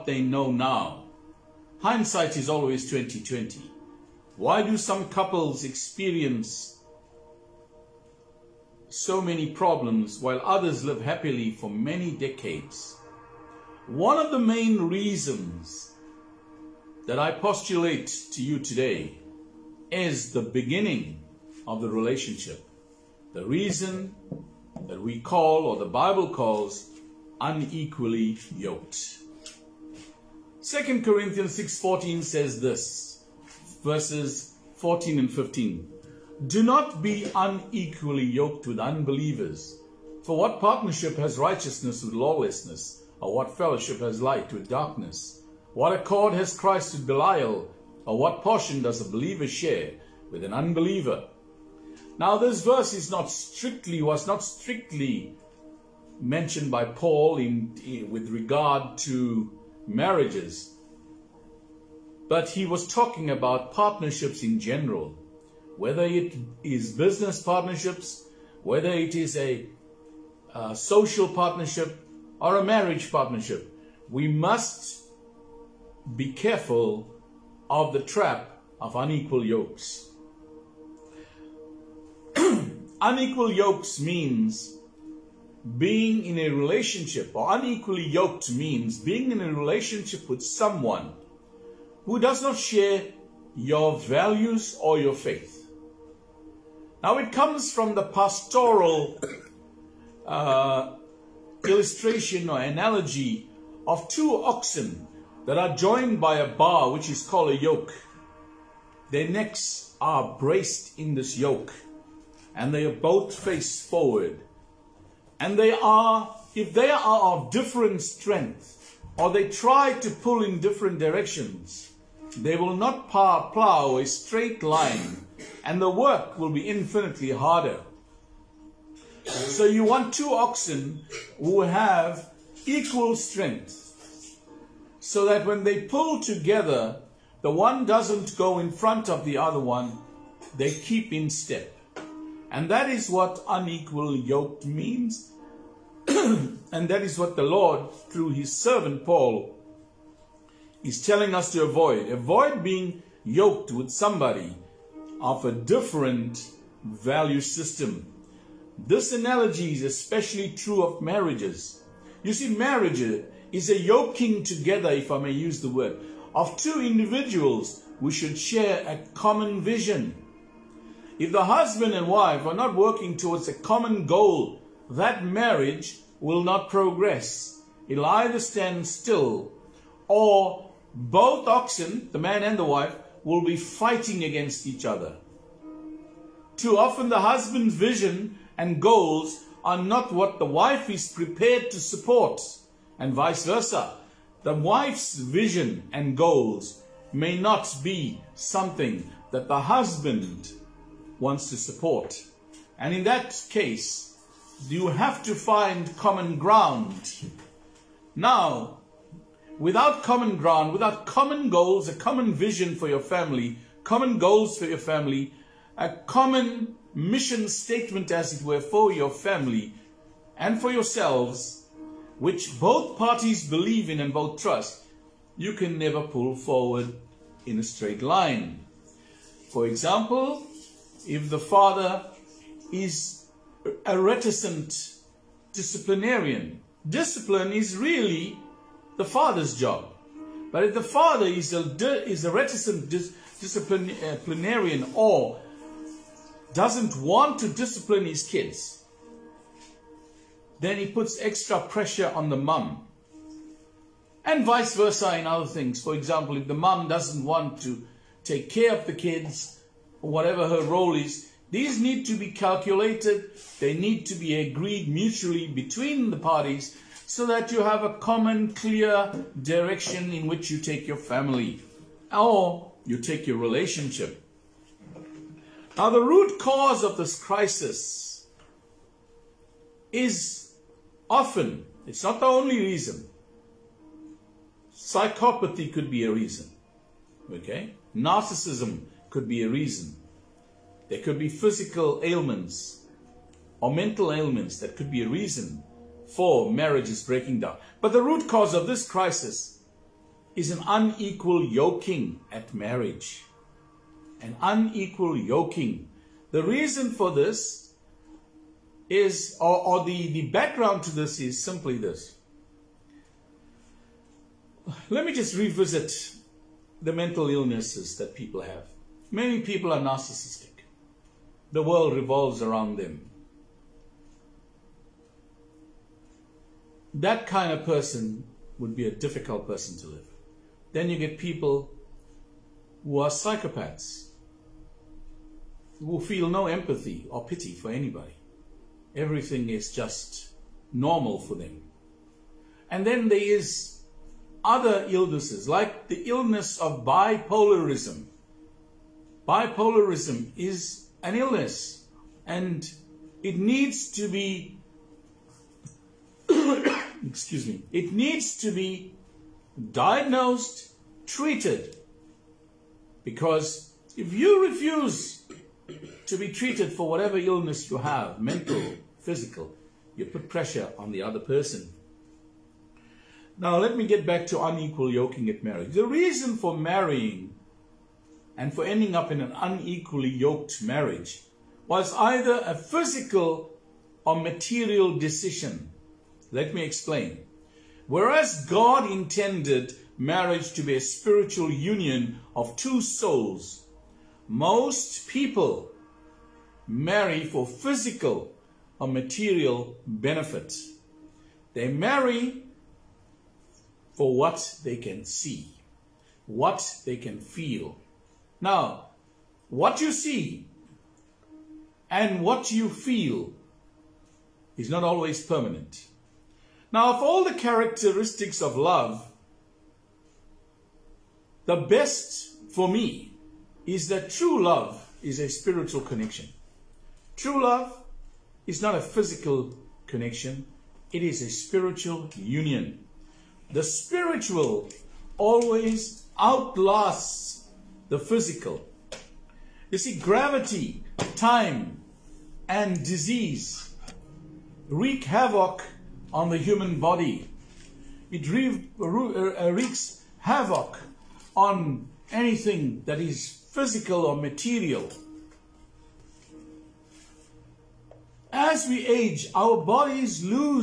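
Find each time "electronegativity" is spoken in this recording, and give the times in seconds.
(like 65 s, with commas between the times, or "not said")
not said.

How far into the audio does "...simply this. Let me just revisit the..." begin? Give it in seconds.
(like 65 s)
311 s.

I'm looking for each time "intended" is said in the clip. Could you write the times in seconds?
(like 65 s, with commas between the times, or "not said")
388 s.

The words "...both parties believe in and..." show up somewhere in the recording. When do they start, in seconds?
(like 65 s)
222 s.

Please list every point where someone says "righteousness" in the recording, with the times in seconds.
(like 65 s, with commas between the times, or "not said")
41 s.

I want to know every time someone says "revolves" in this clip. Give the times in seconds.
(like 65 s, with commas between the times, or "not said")
321 s.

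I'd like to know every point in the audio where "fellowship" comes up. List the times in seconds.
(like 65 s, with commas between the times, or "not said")
43 s.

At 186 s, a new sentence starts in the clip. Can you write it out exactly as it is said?
Too often the husband's vision and goals are not what the wife is prepared to support, and vice versa.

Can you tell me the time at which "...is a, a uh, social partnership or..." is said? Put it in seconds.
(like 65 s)
69 s.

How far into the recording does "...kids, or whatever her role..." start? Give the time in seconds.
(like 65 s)
258 s.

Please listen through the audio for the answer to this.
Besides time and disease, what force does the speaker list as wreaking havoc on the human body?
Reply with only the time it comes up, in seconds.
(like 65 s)
440 s.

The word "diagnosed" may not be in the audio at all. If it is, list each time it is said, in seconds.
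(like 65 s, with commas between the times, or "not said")
359 s.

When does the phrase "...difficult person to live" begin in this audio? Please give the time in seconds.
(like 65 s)
328 s.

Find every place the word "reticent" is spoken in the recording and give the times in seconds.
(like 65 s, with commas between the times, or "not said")
233 s, 242 s.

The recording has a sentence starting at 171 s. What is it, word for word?
If the husband and wife are not working towards a common goal, that marriage will not progress.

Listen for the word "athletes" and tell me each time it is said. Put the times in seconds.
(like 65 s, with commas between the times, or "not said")
not said.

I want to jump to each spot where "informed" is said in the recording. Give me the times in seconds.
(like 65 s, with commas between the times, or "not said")
not said.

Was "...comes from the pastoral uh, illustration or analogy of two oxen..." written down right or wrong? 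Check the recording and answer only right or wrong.
right.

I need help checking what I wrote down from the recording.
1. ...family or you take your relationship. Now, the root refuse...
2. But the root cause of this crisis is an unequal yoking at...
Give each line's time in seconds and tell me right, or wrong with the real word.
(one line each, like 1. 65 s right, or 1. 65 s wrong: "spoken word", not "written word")
1. 270 s wrong: "cause", not "refuse"
2. 297 s right.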